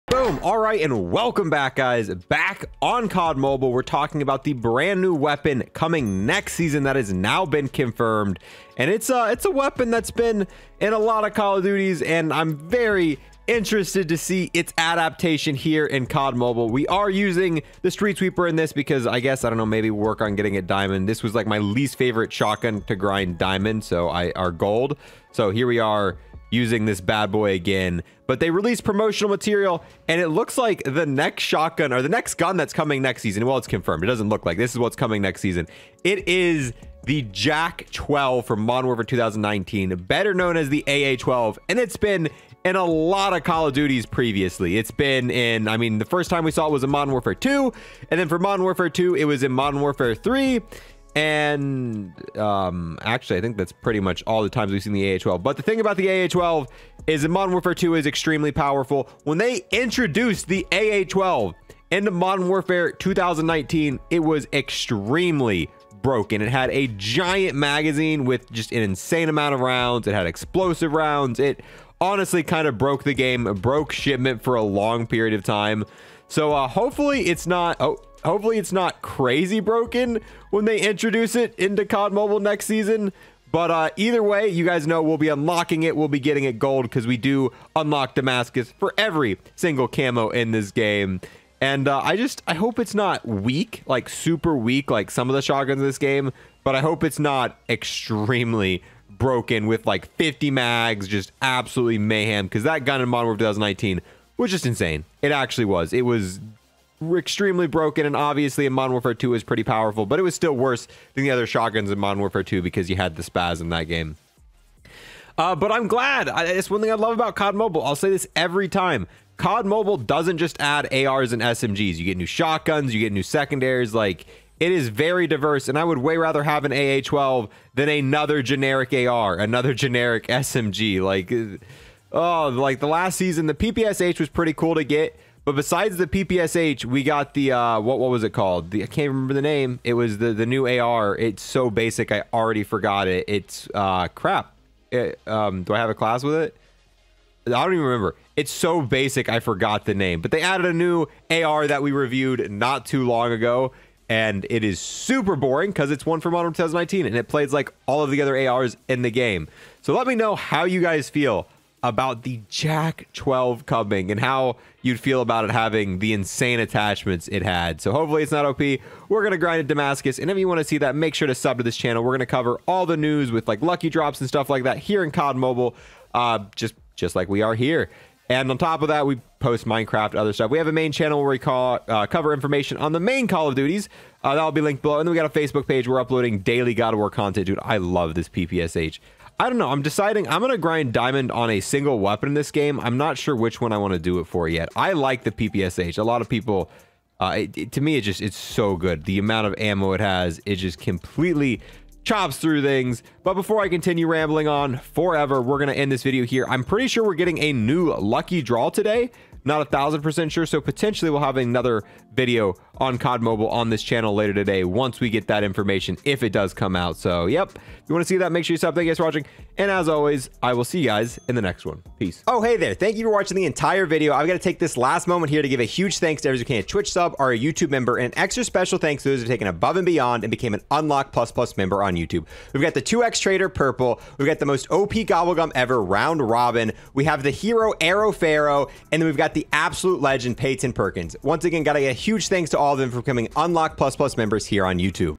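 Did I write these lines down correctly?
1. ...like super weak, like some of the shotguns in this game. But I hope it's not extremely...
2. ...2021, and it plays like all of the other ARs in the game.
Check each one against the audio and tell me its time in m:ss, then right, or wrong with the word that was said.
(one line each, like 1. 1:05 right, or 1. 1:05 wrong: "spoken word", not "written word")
1. 1:33 right
2. 2:36 wrong: "2019", not "2021".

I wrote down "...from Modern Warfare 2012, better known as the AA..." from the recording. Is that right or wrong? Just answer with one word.
wrong.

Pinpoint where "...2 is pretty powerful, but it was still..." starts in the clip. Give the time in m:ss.
1:49.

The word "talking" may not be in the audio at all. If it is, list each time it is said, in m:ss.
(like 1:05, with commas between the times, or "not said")
0:03.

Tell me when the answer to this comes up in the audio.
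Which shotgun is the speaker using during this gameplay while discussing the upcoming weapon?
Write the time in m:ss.
0:17.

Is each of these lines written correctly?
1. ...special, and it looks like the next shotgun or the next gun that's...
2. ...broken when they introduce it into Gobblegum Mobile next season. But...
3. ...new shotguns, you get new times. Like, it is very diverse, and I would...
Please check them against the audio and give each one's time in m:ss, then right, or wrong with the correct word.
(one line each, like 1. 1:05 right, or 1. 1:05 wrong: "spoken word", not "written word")
1. 0:29 wrong: "material", not "special"
2. 1:19 wrong: "COD", not "Gobblegum"
3. 2:02 wrong: "secondaries", not "times".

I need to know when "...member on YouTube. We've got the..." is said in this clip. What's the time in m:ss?
3:51.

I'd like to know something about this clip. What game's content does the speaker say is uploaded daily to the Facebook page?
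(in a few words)
God of War.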